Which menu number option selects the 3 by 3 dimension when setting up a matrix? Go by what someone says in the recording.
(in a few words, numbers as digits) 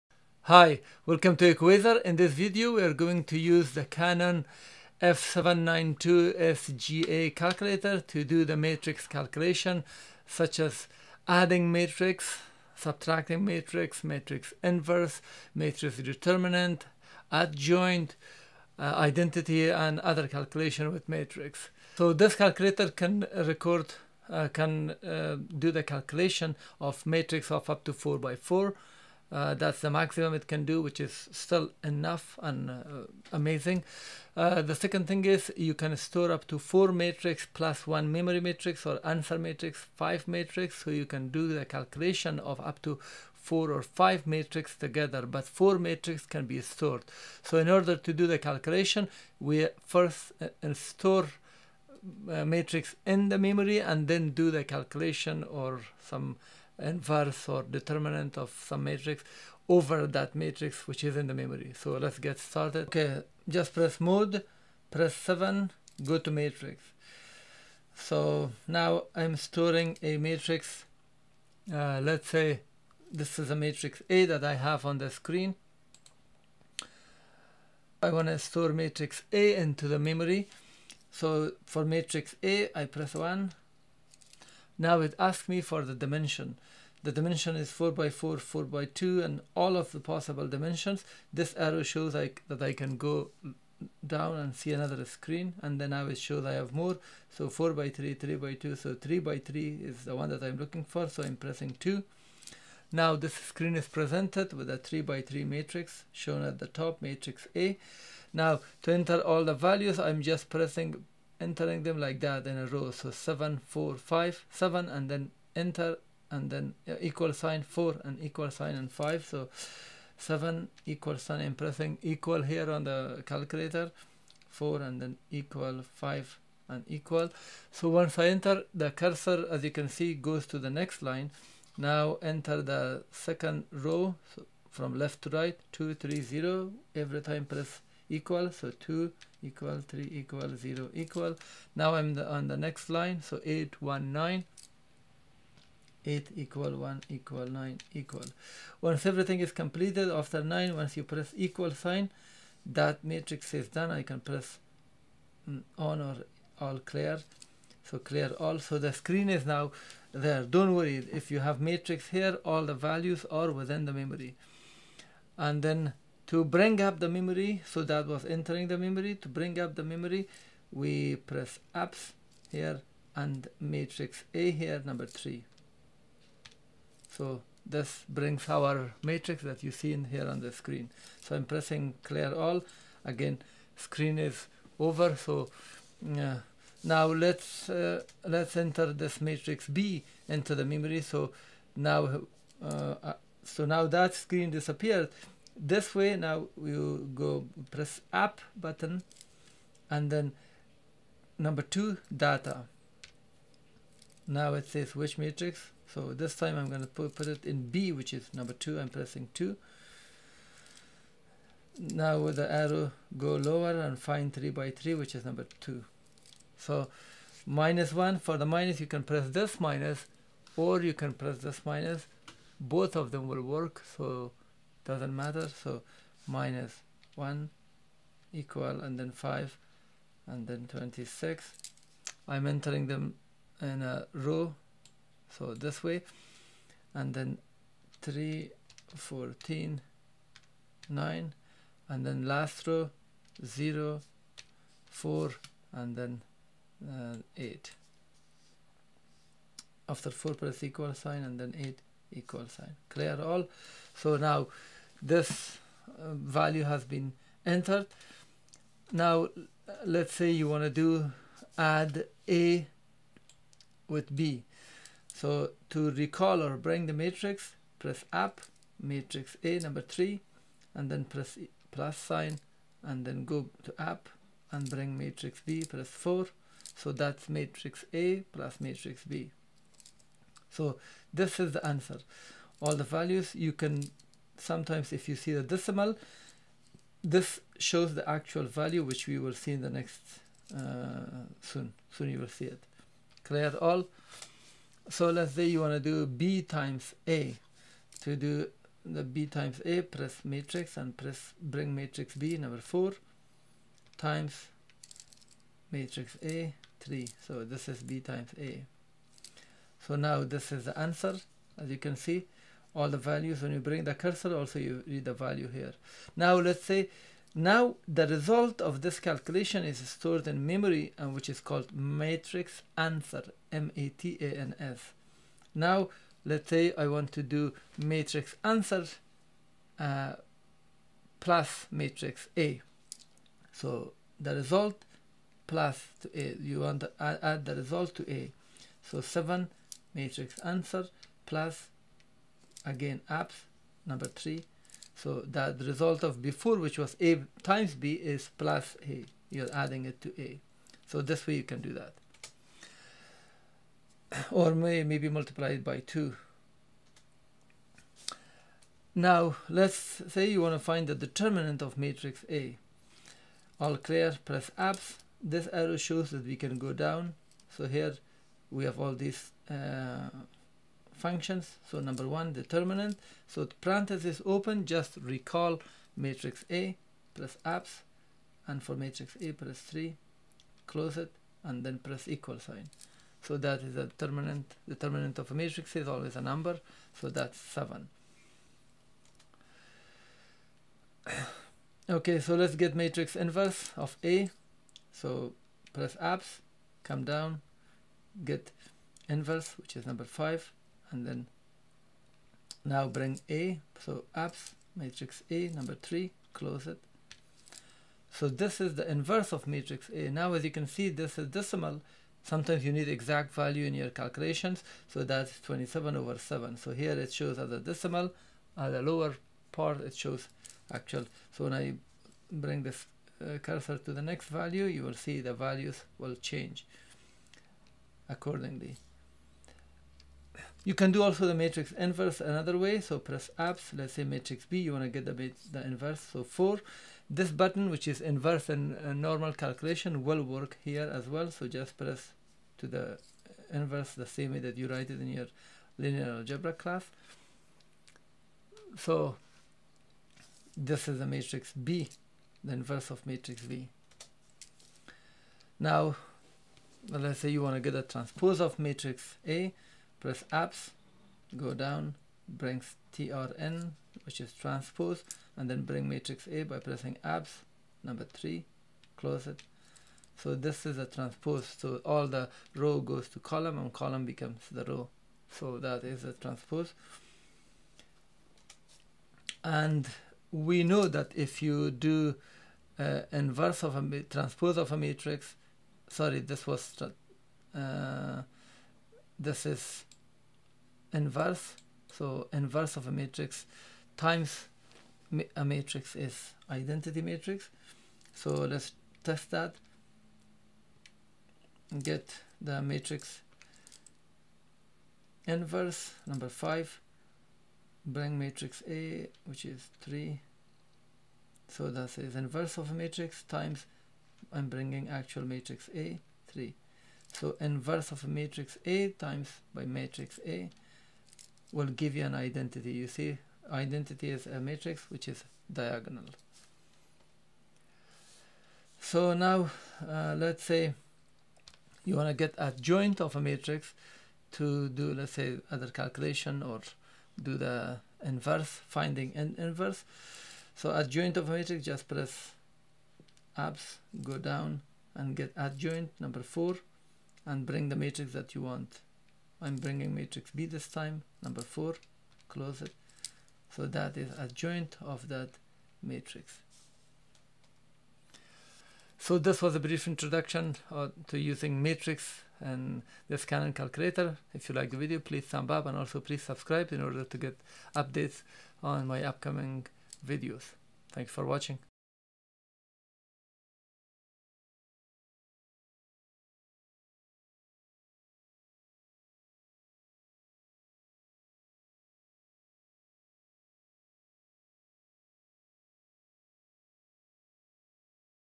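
2.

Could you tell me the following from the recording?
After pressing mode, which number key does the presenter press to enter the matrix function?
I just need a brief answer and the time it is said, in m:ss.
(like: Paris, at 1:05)
7, at 1:04.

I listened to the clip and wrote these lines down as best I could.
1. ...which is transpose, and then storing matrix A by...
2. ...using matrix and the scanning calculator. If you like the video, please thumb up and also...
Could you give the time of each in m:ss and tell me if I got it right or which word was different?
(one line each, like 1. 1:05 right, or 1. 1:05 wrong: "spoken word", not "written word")
1. 7:44 wrong: "bring", not "storing"
2. 9:21 right.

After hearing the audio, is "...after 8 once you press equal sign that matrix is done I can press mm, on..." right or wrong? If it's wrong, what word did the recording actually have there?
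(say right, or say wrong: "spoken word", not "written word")
wrong: "9", not "8".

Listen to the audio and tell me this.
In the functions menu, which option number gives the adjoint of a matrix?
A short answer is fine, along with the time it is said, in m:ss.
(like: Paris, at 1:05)
4, at 9:05.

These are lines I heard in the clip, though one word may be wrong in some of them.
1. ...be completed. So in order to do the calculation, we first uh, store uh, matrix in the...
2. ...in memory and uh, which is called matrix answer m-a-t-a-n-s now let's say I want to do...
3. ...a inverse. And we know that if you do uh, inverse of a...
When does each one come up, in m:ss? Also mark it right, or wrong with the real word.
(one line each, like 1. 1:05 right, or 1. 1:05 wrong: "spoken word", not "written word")
1. 0:46 wrong: "stored", not "completed"
2. 5:20 right
3. 7:56 wrong: "transpose", not "inverse".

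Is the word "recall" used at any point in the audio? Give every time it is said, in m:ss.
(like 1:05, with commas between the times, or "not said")
4:25, 6:15.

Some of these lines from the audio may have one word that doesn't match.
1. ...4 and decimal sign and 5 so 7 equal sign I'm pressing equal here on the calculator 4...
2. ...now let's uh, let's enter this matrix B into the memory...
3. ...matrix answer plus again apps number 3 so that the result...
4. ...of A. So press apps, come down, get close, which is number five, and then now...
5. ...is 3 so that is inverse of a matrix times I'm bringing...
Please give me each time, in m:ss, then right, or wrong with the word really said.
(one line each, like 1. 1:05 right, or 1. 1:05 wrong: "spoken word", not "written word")
1. 1:57 wrong: "equal", not "decimal"
2. 3:06 right
3. 5:39 right
4. 6:33 wrong: "inverse", not "close"
5. 8:29 right.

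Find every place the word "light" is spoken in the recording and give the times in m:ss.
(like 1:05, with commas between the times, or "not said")
not said.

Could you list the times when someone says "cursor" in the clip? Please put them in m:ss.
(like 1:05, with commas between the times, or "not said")
2:08, 5:13, 7:03.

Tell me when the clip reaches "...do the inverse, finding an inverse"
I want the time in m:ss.
8:57.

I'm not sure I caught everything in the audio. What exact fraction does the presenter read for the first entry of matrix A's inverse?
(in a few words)
27/7.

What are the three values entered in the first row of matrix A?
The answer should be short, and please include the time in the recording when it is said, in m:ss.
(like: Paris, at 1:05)
7 4 5, at 1:53.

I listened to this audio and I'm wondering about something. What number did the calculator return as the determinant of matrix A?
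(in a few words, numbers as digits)
7.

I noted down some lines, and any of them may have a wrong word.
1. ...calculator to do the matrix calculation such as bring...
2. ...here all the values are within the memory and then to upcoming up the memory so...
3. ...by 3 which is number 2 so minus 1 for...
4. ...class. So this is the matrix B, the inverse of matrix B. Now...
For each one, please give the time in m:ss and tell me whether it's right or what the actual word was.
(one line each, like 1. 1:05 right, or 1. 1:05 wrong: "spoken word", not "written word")
1. 0:07 wrong: "adding", not "bring"
2. 2:42 wrong: "bring", not "upcoming"
3. 3:34 right
4. 7:26 right.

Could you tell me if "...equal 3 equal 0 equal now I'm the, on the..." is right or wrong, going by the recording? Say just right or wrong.
right.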